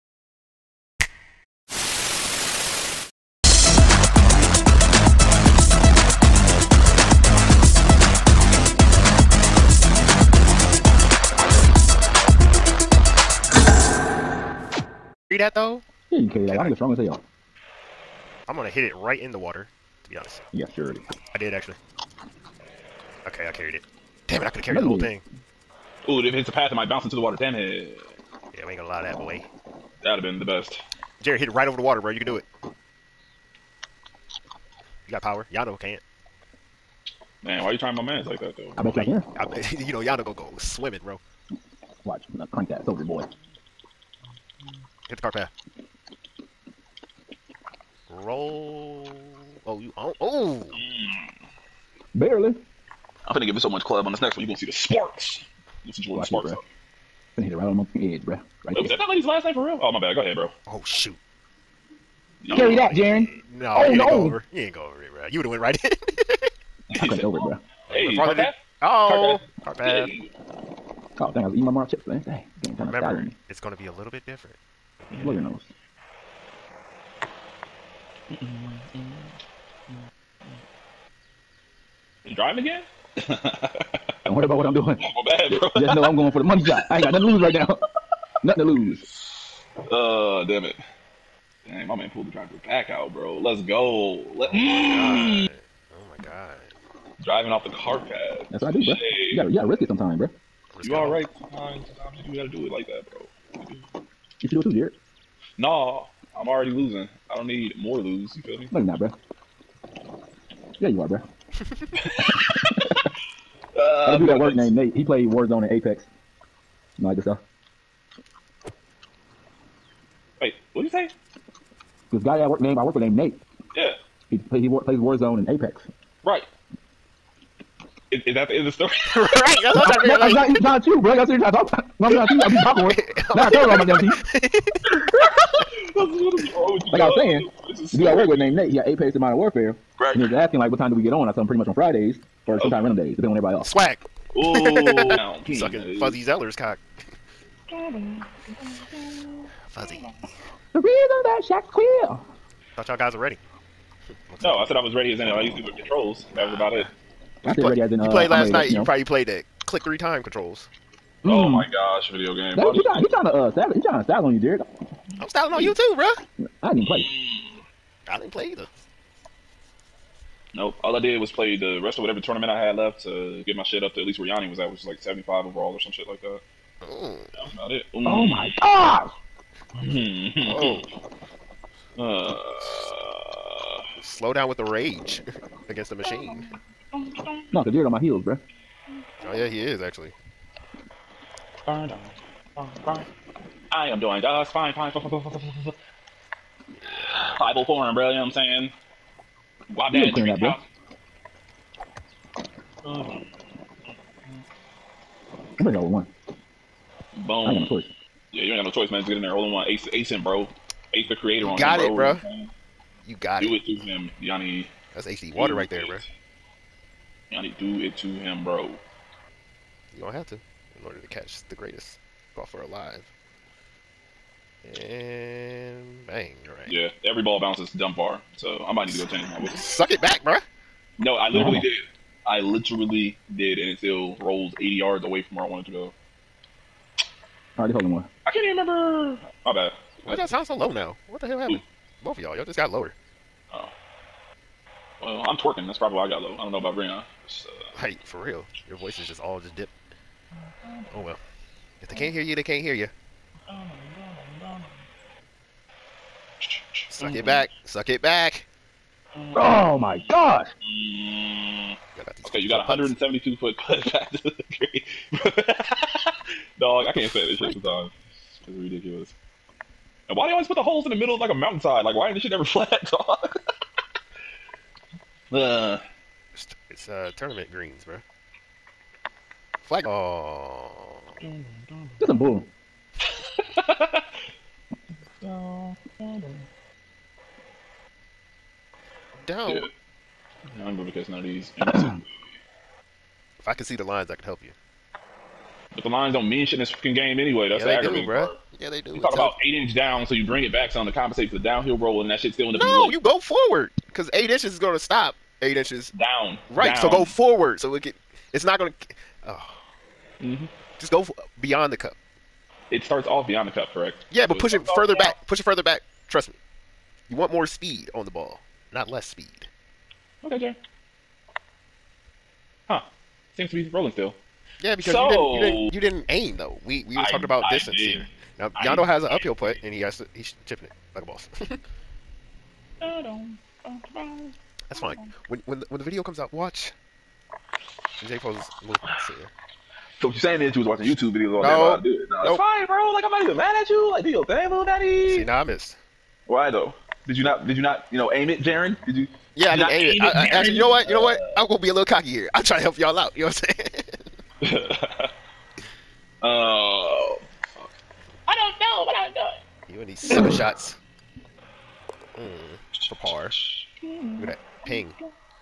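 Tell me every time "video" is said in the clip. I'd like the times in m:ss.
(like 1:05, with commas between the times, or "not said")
2:42, 5:35, 5:41.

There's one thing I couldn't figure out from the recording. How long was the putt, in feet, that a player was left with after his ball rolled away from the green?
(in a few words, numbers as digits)
172 feet.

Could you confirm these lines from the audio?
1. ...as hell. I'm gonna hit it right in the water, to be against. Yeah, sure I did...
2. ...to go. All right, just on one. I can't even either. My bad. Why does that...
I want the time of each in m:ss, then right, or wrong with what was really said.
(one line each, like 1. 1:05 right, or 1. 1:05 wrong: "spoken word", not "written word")
1. 0:16 wrong: "honest", not "against"
2. 3:55 wrong: "remember", not "either".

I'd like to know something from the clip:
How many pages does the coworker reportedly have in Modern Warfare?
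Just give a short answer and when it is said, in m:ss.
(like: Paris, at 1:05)
8, at 2:18.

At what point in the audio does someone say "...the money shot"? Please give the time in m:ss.
1:26.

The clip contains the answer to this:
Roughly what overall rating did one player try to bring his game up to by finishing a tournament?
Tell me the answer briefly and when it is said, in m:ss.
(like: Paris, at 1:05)
75, at 2:54.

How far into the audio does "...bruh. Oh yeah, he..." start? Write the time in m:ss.
3:08.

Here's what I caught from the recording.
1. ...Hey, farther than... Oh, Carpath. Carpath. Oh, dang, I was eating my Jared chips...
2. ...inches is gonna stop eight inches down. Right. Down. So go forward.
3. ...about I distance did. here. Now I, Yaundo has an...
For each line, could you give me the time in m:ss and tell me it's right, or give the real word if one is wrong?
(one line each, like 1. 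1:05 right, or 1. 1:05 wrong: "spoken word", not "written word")
1. 1:07 wrong: "Marl", not "Jared"
2. 5:04 right
3. 5:27 right.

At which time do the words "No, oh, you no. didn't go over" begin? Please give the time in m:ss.
1:03.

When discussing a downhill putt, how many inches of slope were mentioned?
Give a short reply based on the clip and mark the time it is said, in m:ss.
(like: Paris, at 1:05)
8 inches, at 4:59.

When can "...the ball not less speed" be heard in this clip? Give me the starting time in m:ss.
5:18.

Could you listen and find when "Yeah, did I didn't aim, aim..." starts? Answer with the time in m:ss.
5:49.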